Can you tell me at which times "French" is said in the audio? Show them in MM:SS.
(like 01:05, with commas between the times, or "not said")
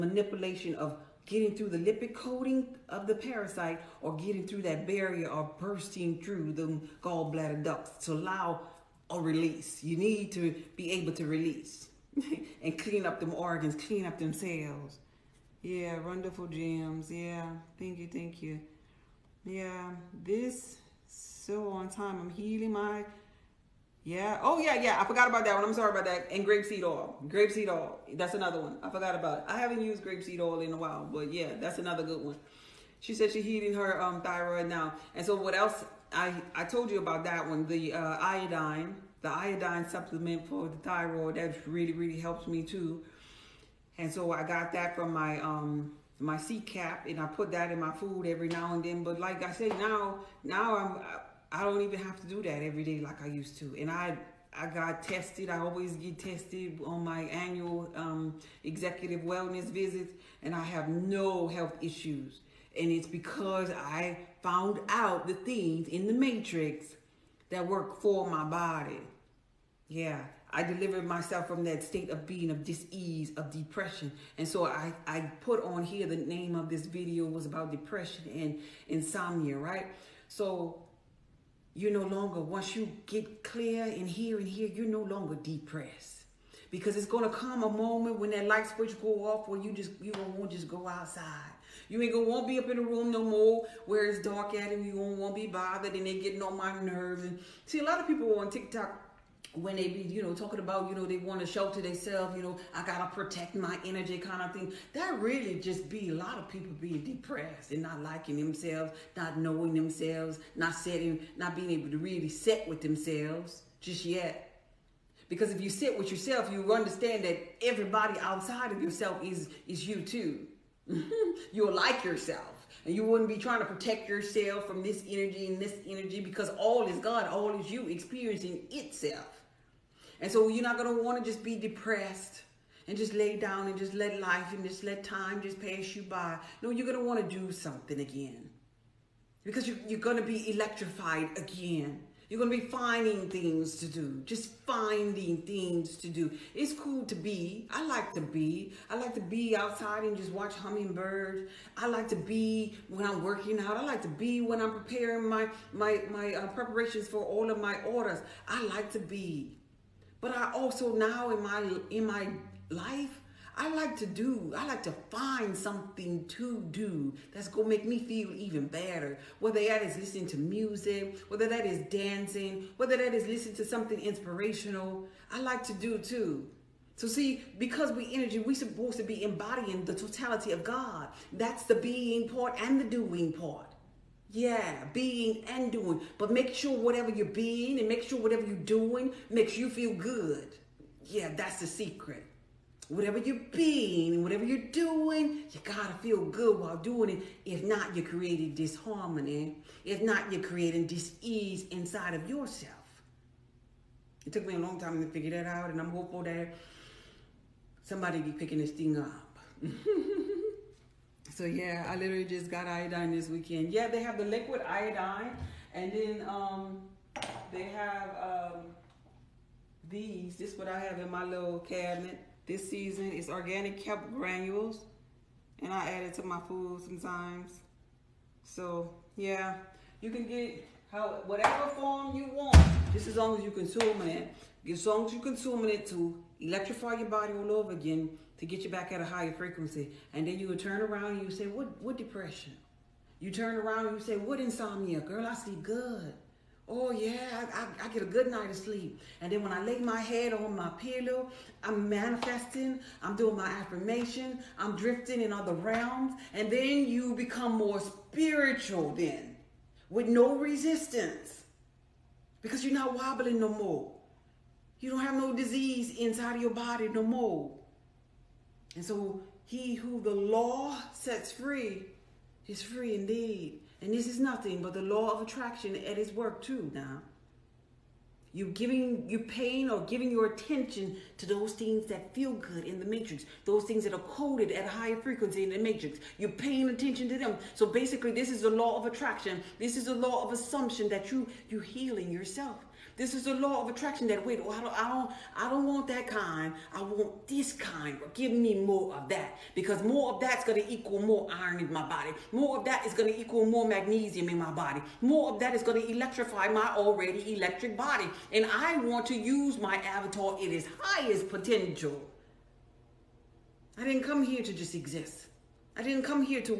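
not said.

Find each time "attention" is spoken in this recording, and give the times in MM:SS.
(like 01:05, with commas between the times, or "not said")
04:40, 04:46.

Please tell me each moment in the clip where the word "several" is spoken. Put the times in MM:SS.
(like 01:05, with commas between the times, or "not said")
not said.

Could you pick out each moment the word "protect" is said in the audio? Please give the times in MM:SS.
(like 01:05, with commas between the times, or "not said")
01:43, 02:03.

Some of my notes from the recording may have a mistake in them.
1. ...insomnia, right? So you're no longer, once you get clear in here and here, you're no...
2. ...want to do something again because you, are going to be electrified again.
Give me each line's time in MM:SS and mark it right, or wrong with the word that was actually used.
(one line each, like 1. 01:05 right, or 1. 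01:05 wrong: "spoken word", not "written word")
1. 01:18 right
2. 02:17 right.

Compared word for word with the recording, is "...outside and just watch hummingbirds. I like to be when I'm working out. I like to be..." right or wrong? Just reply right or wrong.
right.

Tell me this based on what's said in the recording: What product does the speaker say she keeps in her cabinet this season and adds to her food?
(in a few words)
organic kelp granules.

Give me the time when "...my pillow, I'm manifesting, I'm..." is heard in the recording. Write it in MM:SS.
04:10.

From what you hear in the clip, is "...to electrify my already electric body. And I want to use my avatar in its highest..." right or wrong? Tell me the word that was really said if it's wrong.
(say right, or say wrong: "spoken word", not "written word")
right.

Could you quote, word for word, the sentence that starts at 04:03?
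You turn around and you say, What insomnia?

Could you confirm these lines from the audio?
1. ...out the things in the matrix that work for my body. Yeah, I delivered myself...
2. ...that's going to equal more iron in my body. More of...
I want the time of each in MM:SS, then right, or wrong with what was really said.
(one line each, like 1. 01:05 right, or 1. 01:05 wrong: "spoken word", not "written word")
1. 01:04 right
2. 05:00 right.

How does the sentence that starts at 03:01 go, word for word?
That's the being part and the doing part.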